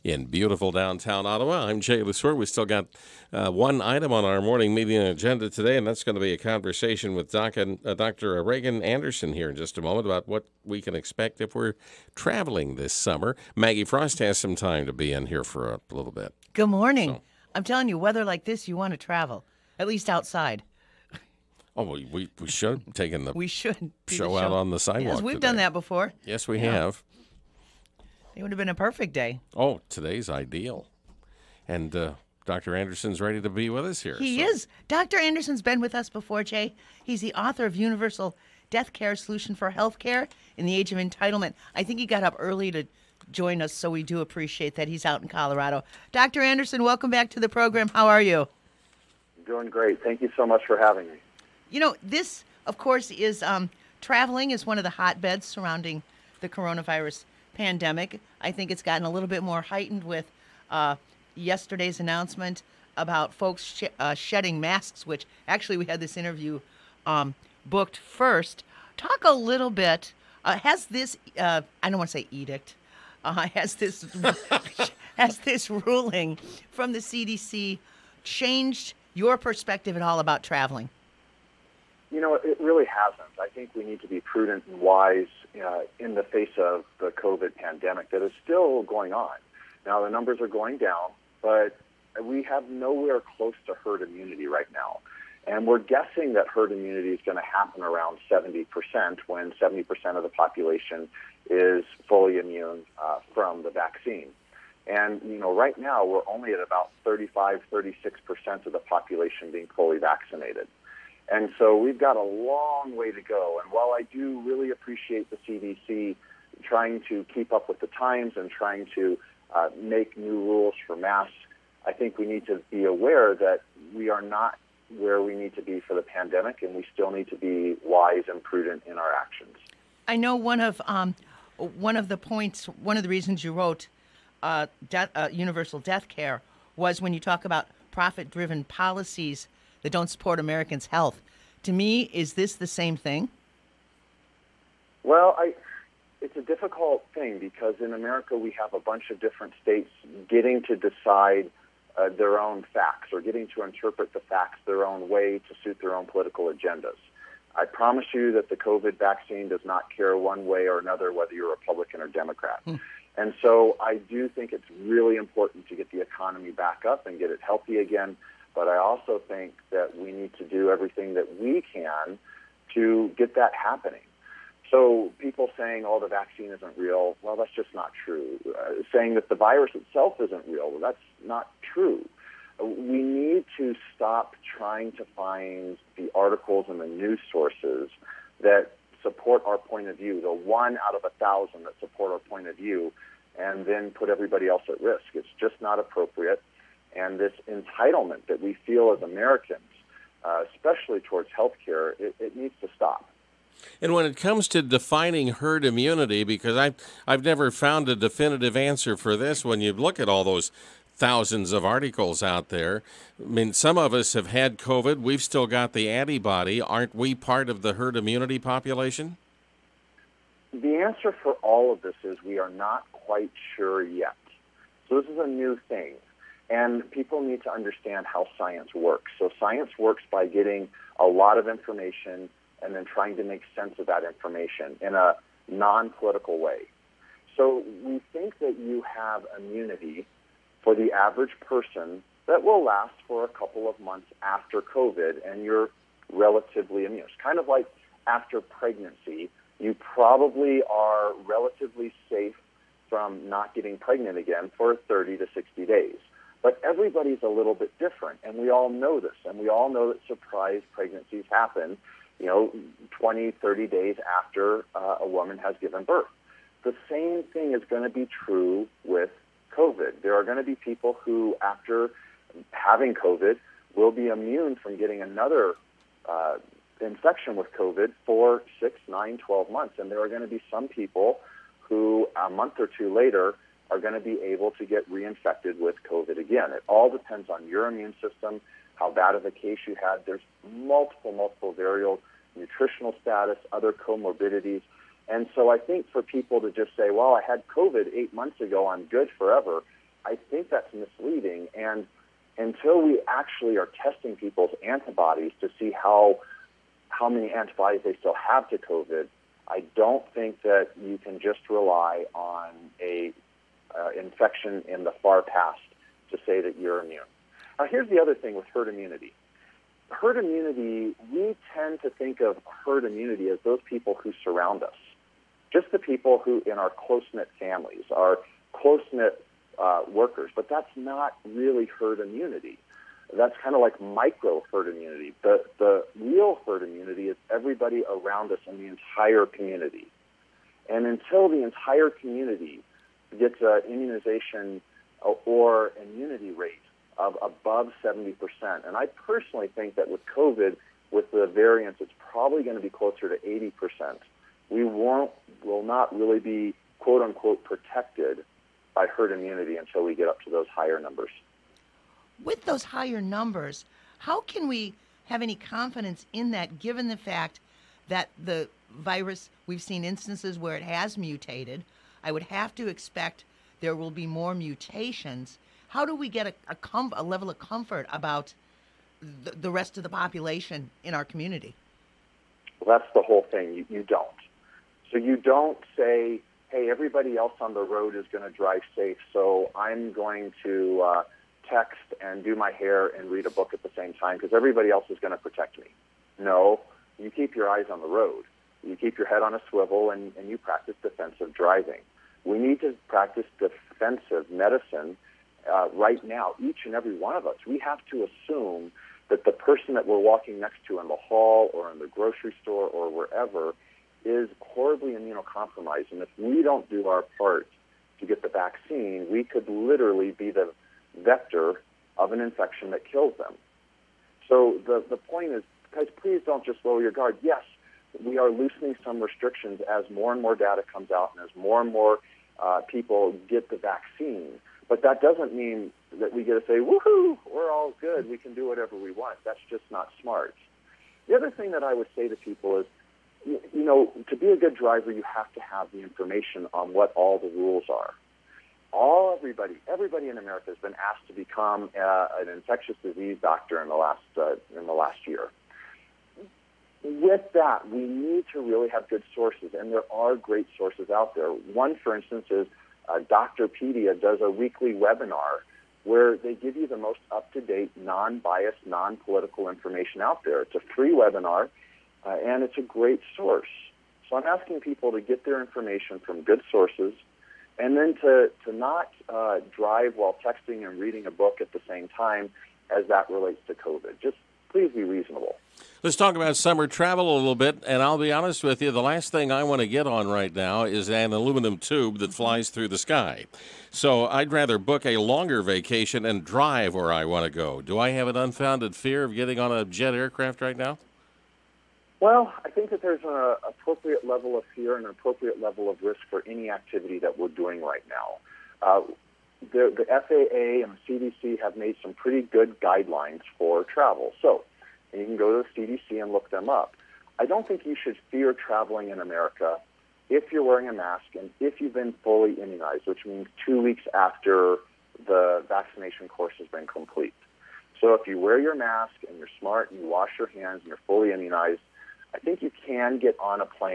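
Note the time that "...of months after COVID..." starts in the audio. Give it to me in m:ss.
4:03.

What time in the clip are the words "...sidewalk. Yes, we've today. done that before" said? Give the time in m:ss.
0:24.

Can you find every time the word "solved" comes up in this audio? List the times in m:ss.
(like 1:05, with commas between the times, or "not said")
not said.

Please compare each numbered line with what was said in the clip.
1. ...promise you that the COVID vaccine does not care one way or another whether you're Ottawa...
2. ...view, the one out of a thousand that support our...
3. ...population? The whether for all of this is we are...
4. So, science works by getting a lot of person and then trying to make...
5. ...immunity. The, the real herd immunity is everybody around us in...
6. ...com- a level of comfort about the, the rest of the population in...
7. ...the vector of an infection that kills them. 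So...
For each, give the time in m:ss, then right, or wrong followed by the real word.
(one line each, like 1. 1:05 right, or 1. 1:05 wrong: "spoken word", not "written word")
1. 2:37 wrong: "Republican", not "Ottawa"
2. 3:09 right
3. 3:38 wrong: "answer", not "whether"
4. 3:49 wrong: "information", not "person"
5. 5:34 right
6. 6:16 right
7. 7:00 right.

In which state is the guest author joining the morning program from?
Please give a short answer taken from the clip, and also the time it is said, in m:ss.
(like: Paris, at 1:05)
Colorado, at 0:45.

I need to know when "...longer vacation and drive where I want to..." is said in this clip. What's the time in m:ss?
8:14.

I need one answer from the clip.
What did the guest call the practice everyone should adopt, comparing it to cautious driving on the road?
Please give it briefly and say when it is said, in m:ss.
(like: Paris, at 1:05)
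defensive medicine, at 6:43.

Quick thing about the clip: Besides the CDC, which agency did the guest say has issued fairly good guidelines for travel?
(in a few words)
FAA.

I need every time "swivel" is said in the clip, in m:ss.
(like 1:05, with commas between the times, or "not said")
6:39.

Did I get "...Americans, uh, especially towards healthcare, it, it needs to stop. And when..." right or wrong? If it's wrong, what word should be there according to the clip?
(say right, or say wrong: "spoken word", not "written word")
right.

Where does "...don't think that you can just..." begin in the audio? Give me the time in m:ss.
5:09.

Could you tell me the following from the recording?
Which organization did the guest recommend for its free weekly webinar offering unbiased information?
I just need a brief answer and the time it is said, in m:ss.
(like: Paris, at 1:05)
Doctorpedia, at 7:42.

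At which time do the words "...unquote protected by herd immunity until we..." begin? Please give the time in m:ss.
5:57.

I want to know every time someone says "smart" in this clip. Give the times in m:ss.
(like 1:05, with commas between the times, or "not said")
7:19, 8:49.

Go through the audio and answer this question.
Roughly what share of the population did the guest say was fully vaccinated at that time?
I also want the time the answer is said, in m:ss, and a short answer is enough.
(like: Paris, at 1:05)
35, 36%, at 1:47.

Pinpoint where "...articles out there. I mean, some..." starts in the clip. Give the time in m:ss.
3:31.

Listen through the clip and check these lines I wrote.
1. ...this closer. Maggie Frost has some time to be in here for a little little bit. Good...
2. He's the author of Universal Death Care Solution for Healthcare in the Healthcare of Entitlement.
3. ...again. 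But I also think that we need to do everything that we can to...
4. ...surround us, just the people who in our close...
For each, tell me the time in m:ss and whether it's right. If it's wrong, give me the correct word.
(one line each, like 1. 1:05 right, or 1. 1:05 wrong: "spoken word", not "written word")
1. 0:12 wrong: "summer", not "closer"
2. 0:37 wrong: "Age", not "Healthcare"
3. 2:47 right
4. 5:24 right.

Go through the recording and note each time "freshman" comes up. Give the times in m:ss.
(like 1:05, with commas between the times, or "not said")
not said.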